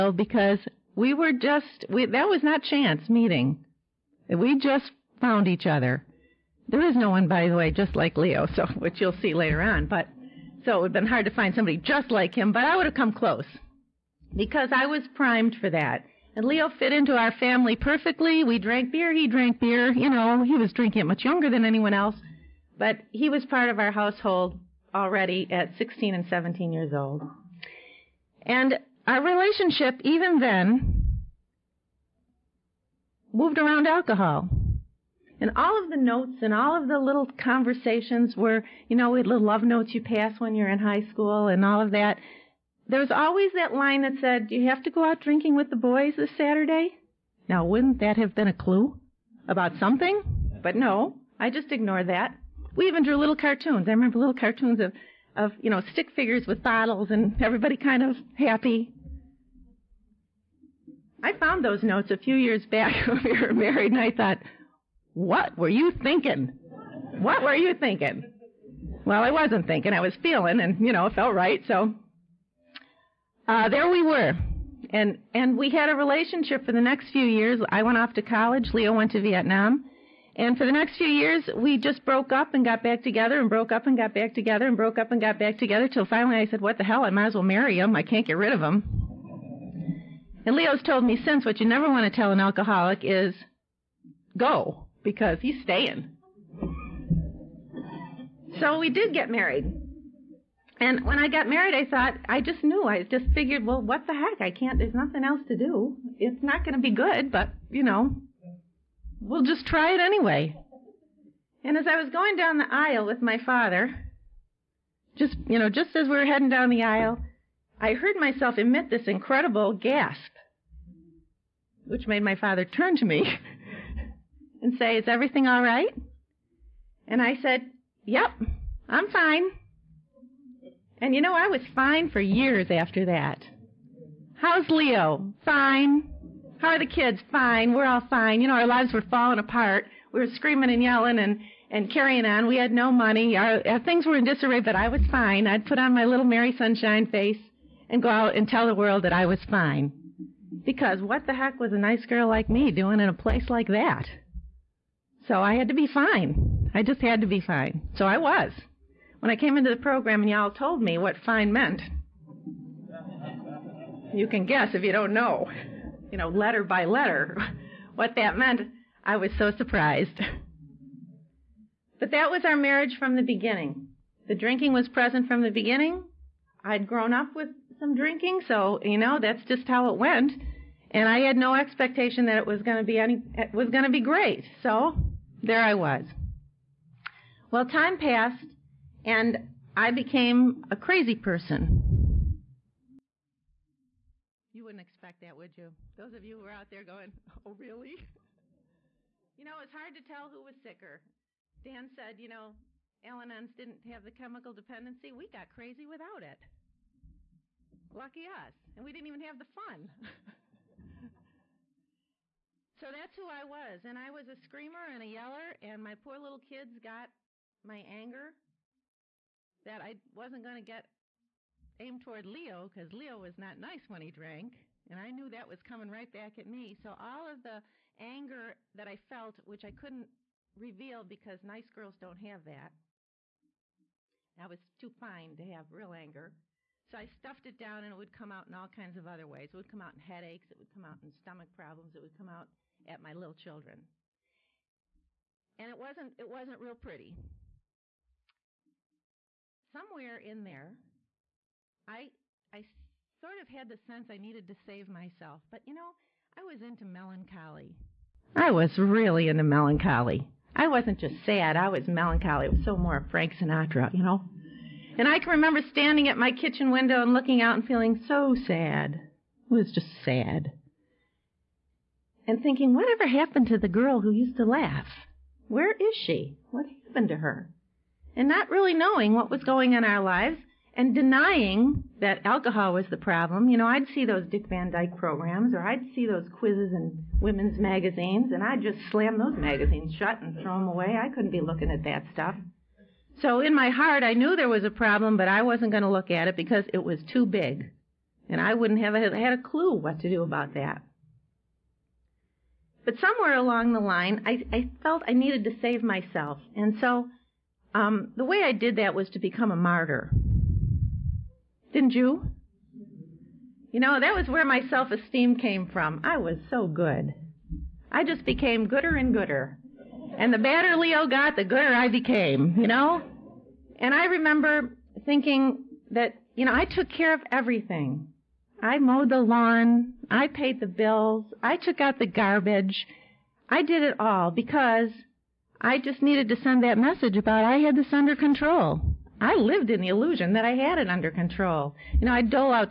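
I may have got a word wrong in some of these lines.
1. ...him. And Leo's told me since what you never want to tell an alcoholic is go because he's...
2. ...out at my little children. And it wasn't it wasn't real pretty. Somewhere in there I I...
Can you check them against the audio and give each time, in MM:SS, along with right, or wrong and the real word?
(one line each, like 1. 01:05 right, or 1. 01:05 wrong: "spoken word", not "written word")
1. 01:28 right
2. 04:02 right.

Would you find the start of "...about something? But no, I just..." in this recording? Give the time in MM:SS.
00:49.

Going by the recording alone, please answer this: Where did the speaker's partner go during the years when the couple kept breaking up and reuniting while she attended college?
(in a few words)
Vietnam.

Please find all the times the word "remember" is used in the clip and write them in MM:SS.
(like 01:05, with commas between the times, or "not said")
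00:53, 04:25, 05:24.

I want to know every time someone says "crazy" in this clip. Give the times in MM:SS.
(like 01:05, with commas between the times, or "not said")
03:10, 03:25.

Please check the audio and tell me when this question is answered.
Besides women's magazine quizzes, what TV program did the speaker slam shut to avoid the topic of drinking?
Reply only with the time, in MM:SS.
04:44.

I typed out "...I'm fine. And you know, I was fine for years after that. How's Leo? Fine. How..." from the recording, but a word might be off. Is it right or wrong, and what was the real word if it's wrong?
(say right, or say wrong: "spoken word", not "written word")
right.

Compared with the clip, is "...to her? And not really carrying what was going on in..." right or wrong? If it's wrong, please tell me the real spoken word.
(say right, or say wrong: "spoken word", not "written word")
wrong: "knowing", not "carrying".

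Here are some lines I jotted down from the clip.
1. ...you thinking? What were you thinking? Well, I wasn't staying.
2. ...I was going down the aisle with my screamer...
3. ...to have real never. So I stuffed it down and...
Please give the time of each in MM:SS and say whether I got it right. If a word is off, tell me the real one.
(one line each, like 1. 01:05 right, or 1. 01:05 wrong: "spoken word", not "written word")
1. 01:05 wrong: "thinking", not "staying"
2. 01:51 wrong: "father", not "screamer"
3. 03:55 wrong: "anger", not "never".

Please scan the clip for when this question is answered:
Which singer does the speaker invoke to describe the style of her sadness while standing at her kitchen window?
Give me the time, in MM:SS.
04:23.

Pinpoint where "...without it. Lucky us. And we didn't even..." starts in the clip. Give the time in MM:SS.
03:25.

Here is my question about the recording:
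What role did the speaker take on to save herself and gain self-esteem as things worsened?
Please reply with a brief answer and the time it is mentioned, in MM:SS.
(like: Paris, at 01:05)
A martyr, at 05:09.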